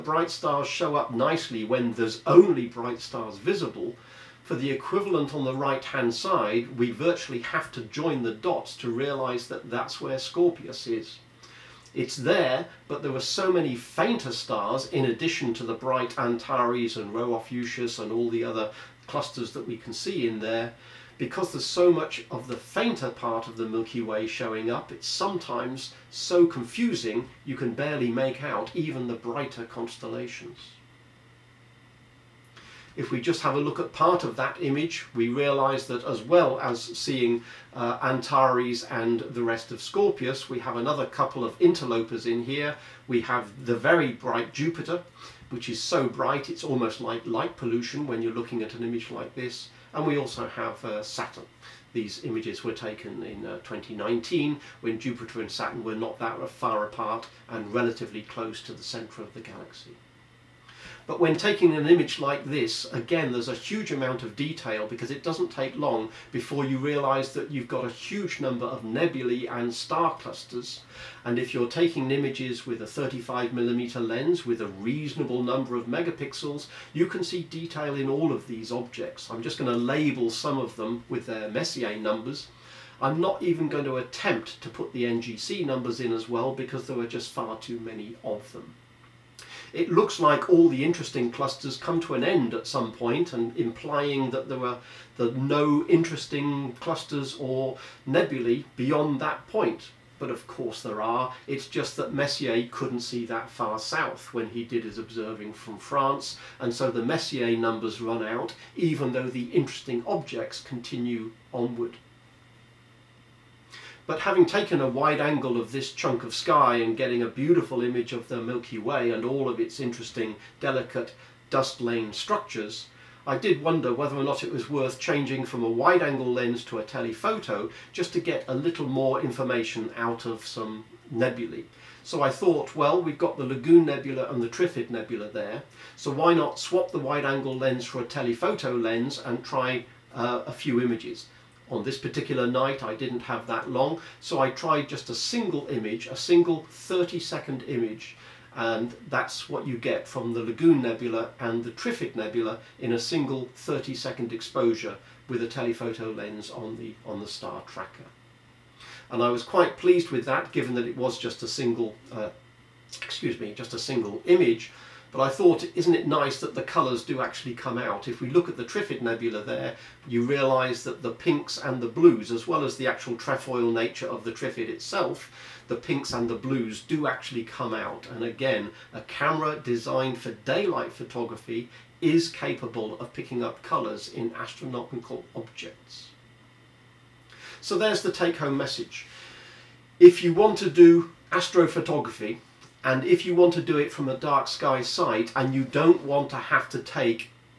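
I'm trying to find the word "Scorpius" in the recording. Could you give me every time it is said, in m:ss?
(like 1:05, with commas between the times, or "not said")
0:10, 0:39.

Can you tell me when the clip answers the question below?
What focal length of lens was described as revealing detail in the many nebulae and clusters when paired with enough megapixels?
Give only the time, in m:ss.
1:12.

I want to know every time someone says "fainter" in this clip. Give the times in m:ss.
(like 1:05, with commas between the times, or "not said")
0:13, 0:22.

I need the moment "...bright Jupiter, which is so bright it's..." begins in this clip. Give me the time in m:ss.
0:44.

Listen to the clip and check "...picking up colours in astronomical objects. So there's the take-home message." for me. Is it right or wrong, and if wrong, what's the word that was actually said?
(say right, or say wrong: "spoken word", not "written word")
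right.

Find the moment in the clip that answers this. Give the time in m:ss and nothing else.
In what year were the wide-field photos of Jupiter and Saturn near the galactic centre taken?
0:53.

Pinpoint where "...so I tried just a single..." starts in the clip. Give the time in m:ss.
2:24.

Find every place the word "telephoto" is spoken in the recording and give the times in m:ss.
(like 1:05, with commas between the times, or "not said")
2:06, 2:18, 2:35.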